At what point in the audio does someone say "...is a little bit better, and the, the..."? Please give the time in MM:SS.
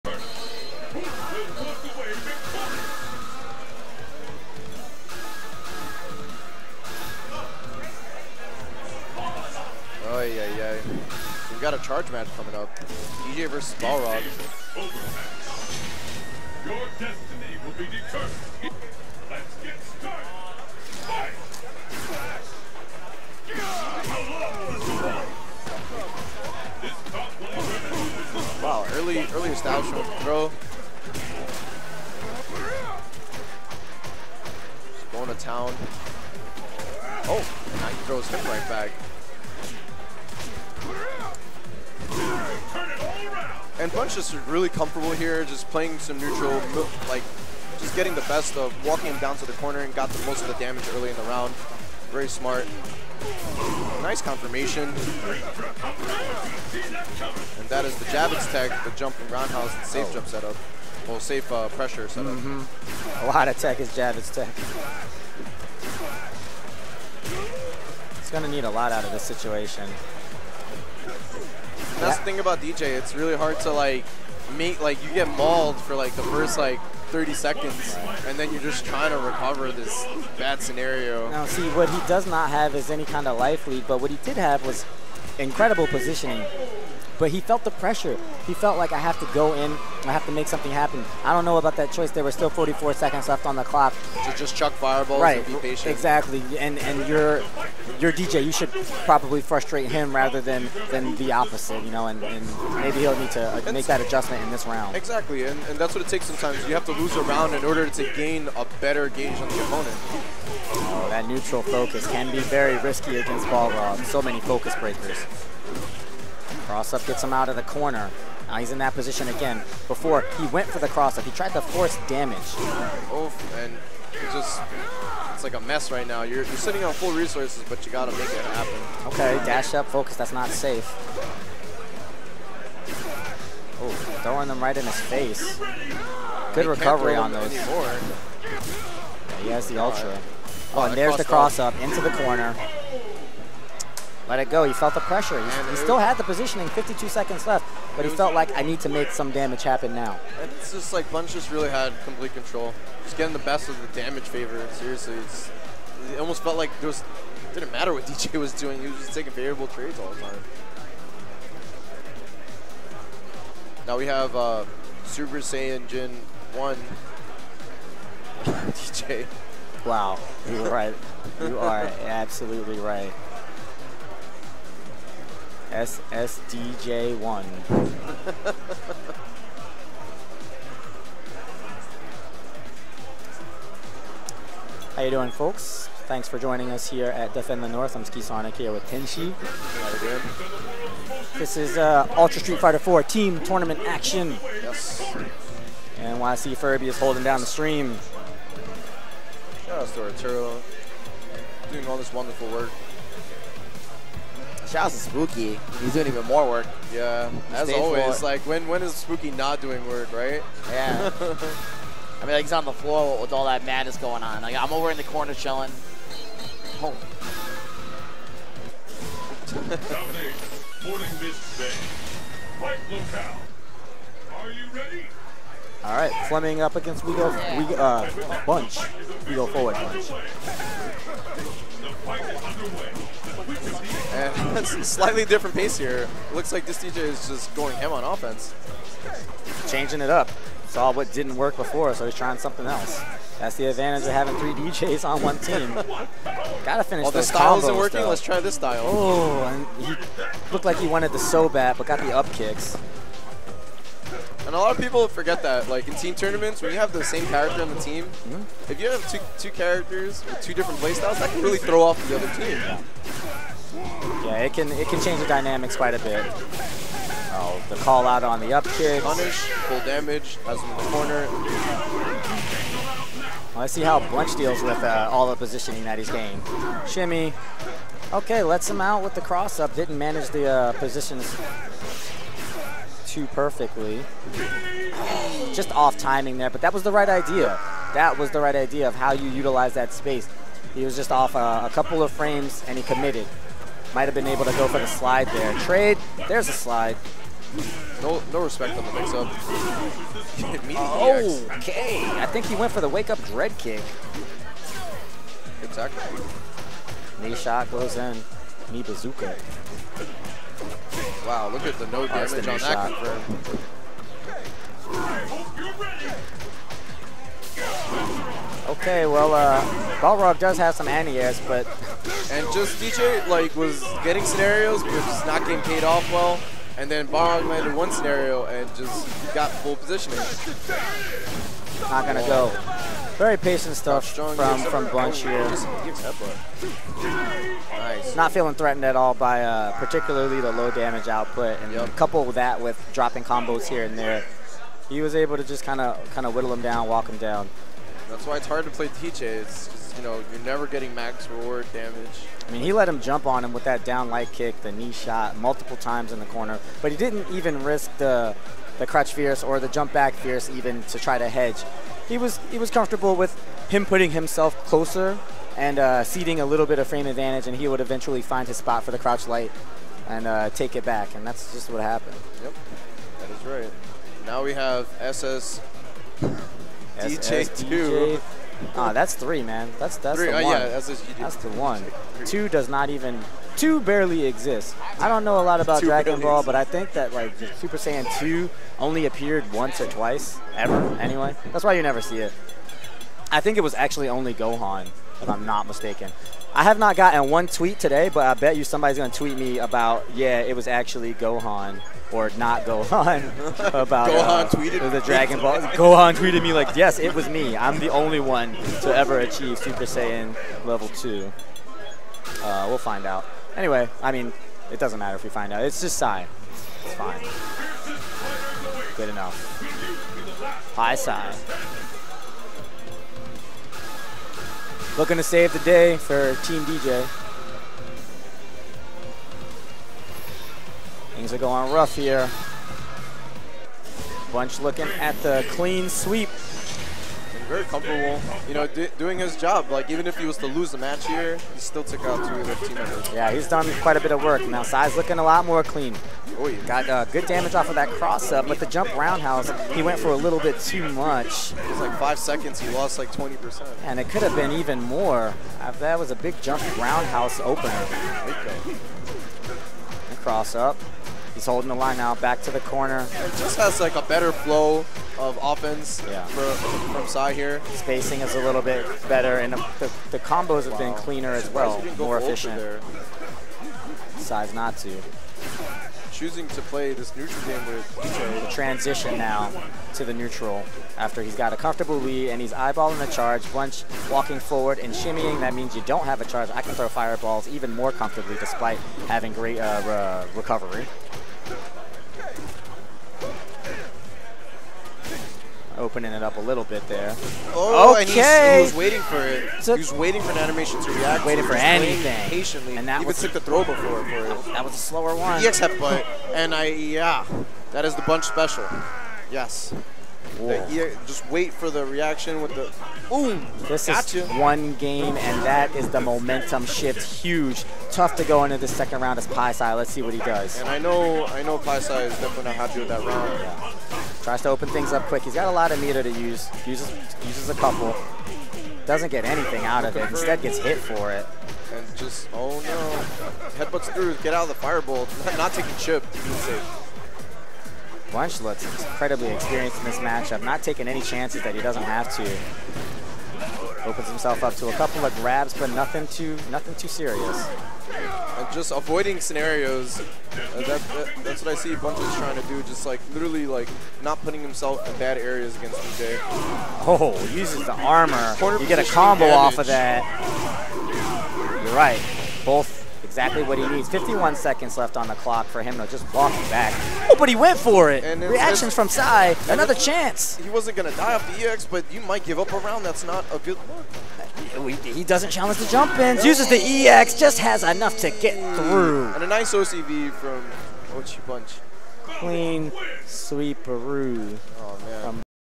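07:48.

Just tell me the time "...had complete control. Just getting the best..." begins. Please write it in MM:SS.
02:31.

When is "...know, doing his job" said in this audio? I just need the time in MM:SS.
07:18.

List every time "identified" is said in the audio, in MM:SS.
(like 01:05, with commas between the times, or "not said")
not said.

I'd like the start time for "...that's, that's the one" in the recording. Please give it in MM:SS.
06:20.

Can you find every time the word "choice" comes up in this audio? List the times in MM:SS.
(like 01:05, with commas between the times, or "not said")
01:31.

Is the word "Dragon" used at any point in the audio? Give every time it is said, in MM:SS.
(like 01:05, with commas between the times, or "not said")
06:25, 06:45.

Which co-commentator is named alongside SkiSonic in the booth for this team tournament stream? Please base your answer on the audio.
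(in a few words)
Tenshi.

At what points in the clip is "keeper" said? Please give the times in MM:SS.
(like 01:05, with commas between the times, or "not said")
not said.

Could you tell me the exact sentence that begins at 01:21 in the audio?
Now, see, what he does not have is any kind of life lead, but what he did have was incredible positioning.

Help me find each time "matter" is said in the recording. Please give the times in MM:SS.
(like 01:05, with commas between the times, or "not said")
02:37, 06:54.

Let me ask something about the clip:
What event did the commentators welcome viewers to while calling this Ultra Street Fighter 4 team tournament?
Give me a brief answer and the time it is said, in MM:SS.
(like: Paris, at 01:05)
Defend the North, at 03:07.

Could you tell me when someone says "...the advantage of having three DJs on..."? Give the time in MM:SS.
04:03.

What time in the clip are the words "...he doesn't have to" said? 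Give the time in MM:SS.
09:01.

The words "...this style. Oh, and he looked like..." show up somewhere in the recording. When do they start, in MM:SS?
04:08.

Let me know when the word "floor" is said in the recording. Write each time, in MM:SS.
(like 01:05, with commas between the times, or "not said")
03:28, 03:32.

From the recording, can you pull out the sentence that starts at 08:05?
That means you don't have a charge.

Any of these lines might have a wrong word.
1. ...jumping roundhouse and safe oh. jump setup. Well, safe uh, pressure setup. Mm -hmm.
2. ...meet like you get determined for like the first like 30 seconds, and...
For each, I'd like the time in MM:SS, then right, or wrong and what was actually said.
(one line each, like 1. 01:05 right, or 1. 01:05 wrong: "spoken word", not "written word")
1. 00:58 right
2. 01:14 wrong: "mauled", not "determined".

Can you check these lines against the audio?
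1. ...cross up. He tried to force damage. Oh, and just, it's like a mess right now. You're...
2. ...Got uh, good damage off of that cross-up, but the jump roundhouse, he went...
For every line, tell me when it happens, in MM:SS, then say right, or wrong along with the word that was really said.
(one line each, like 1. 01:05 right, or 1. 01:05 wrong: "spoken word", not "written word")
1. 02:00 right
2. 07:26 right.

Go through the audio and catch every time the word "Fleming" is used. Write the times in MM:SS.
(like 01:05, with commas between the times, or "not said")
03:46.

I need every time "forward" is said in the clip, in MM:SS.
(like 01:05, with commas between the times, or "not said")
03:49, 08:04.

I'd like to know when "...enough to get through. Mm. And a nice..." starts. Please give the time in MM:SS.
09:37.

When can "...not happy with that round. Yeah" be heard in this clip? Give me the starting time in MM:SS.
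08:42.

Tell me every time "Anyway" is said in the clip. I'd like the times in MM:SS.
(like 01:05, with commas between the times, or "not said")
06:31, 06:53.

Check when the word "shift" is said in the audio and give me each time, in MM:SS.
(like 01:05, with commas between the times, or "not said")
08:36.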